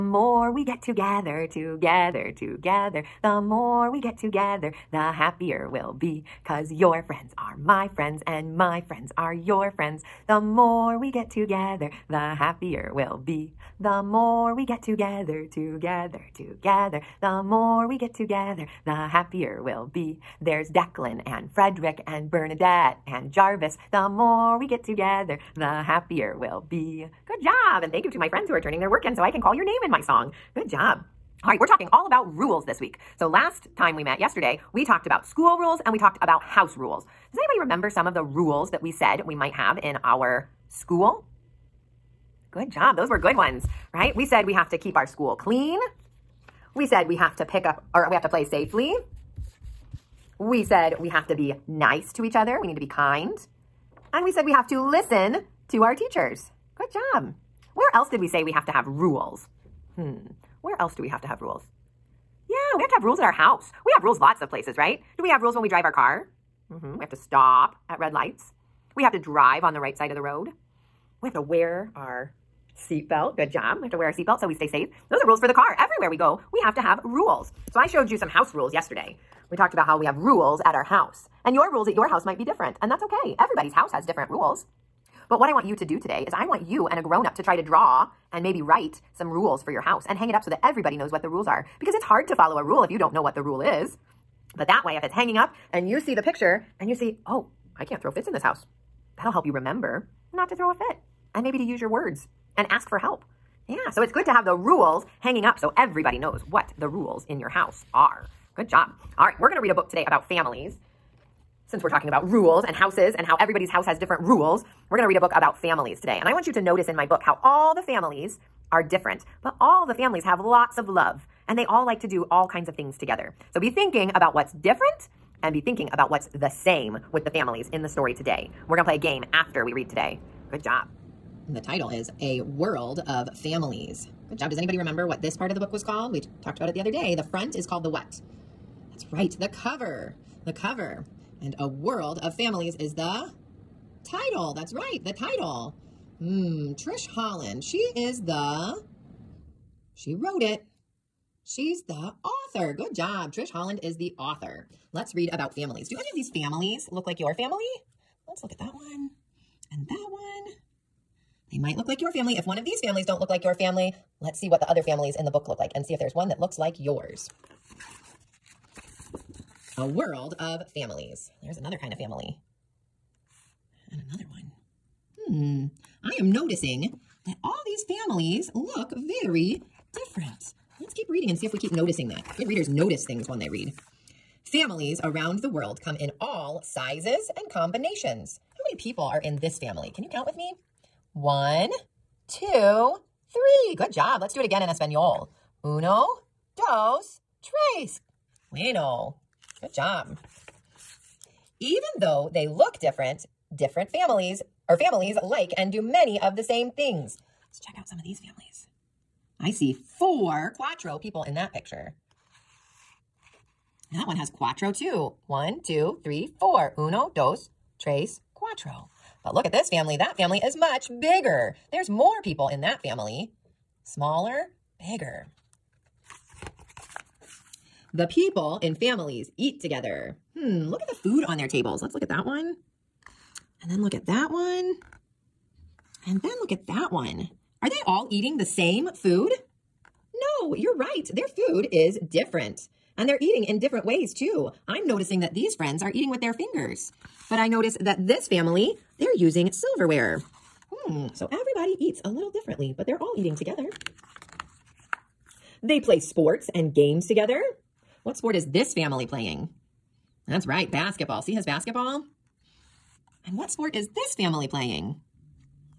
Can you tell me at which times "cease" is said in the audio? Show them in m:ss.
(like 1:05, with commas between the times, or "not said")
not said.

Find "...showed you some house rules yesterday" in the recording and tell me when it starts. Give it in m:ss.
1:17.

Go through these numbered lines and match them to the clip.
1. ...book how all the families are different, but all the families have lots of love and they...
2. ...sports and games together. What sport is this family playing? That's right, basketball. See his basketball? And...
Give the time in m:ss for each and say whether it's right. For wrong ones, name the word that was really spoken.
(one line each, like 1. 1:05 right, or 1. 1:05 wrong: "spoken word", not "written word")
1. 1:57 right
2. 4:15 right.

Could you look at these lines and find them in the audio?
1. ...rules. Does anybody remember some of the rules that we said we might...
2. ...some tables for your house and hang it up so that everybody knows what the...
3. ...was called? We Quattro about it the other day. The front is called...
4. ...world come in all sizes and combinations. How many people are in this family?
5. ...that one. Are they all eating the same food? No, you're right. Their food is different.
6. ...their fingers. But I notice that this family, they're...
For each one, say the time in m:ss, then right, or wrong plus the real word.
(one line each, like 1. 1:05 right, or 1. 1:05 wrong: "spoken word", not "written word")
1. 0:36 right
2. 1:29 wrong: "rules", not "tables"
3. 2:15 wrong: "Talked", not "Quattro"
4. 3:05 right
5. 3:56 right
6. 4:06 right.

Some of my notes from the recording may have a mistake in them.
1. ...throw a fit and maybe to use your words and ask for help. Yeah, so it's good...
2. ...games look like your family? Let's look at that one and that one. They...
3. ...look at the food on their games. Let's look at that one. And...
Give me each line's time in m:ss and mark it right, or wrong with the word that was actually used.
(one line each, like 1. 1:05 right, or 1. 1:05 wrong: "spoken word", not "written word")
1. 1:40 right
2. 2:36 wrong: "families", not "games"
3. 3:50 wrong: "tables", not "games".